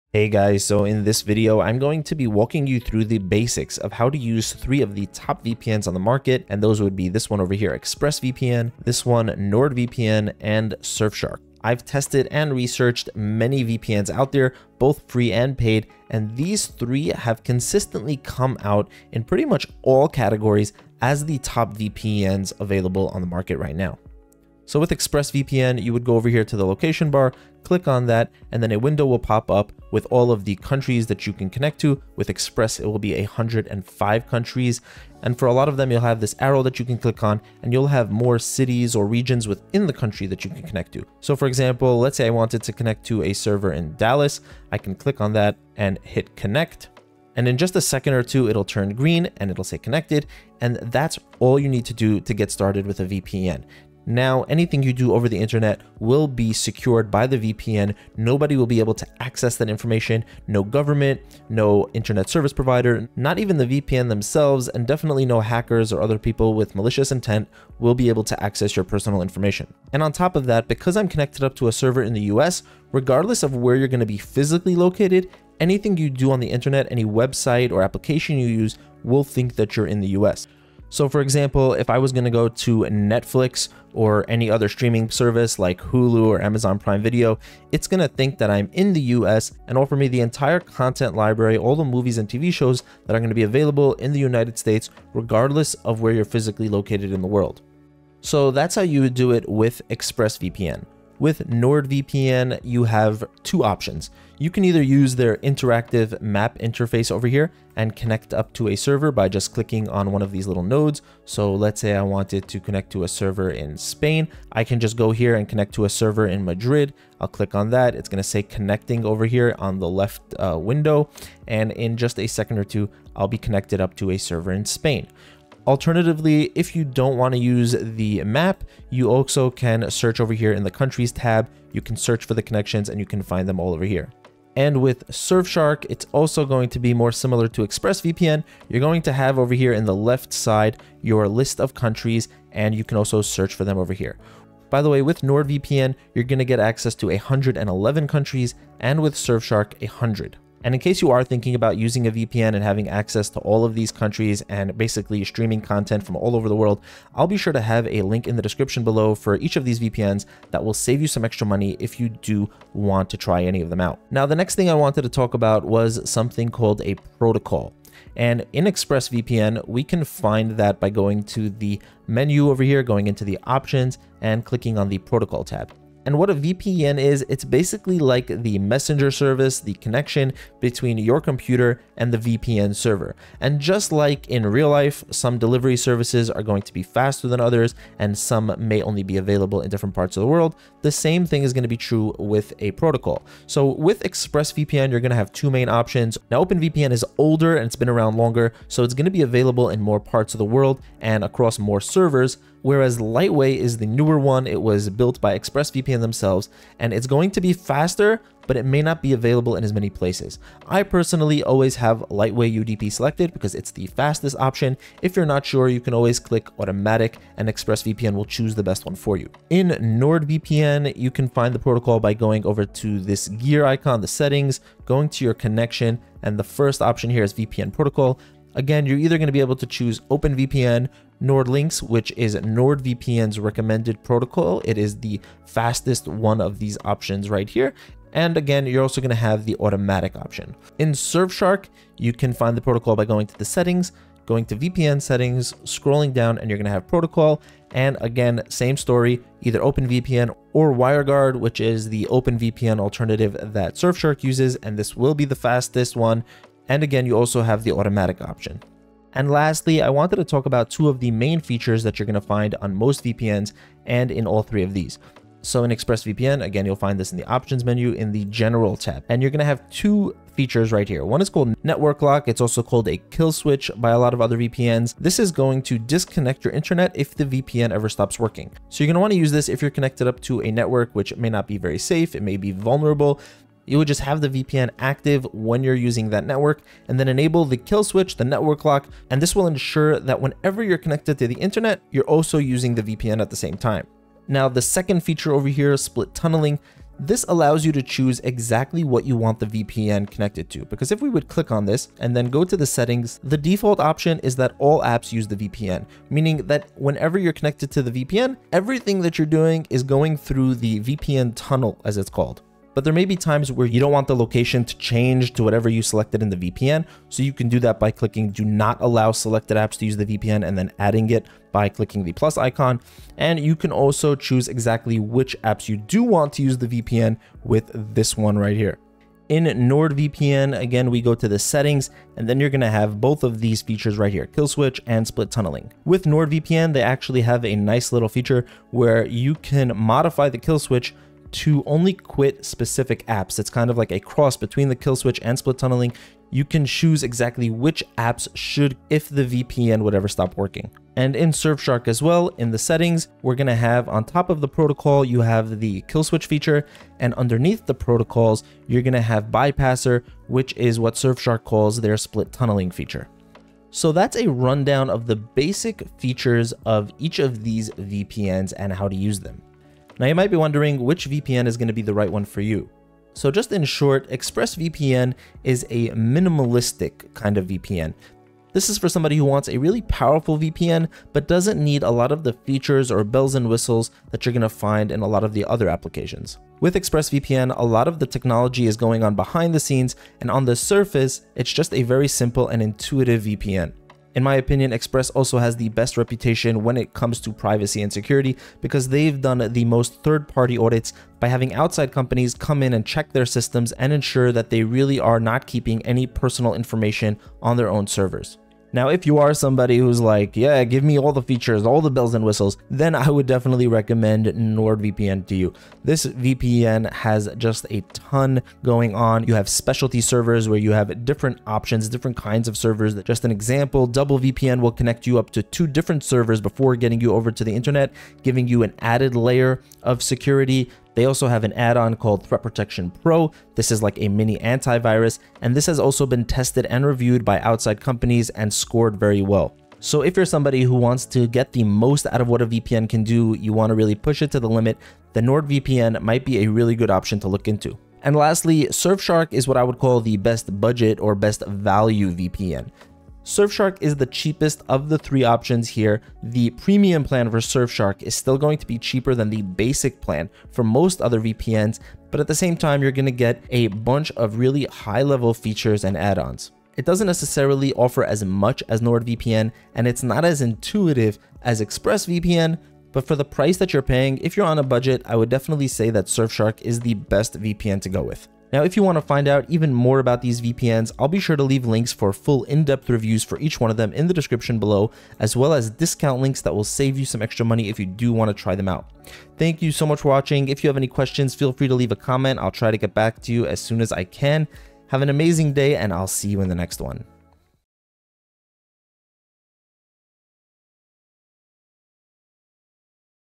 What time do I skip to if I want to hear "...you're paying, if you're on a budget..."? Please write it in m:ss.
7:53.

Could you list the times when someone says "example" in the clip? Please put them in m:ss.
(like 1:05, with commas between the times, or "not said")
0:41, 1:21, 7:03.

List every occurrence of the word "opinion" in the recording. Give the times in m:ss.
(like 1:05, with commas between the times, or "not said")
6:34.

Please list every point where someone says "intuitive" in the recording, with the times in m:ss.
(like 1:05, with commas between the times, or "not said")
6:32, 7:50.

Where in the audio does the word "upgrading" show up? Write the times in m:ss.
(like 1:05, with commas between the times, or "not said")
not said.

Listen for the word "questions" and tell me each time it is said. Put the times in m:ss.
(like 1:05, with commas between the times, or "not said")
8:10.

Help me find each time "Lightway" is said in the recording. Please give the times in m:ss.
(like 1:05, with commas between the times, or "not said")
3:22, 3:32.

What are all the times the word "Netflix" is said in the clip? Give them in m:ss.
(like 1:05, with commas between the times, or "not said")
1:22.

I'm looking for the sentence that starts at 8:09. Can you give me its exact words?
Thank you so much for watching.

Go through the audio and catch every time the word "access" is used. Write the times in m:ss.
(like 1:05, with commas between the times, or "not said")
0:59, 1:08, 2:26, 2:32.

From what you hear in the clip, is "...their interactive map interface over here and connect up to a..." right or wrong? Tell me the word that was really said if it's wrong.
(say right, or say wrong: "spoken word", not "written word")
right.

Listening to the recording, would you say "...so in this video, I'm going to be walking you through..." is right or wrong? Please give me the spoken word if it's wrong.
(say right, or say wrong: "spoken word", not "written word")
right.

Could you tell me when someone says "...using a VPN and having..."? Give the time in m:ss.
2:31.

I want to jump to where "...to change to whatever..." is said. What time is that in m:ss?
5:14.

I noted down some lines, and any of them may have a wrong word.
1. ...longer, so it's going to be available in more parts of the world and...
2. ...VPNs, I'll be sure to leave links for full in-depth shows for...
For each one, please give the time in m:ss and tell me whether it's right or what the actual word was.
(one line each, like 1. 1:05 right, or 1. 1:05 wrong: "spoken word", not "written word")
1. 3:18 right
2. 8:00 wrong: "reviews", not "shows".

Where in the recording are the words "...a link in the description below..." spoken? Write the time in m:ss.
2:37.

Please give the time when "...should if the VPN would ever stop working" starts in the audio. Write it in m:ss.
5:48.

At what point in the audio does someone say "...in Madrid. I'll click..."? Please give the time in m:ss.
1:56.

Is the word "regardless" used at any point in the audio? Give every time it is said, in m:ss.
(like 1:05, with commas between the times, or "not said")
1:12, 1:35.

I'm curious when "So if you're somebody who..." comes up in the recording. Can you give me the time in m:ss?
7:19.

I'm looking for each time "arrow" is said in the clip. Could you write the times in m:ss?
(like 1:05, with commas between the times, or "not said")
0:36.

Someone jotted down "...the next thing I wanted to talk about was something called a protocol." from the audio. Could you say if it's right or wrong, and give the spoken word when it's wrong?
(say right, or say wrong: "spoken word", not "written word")
right.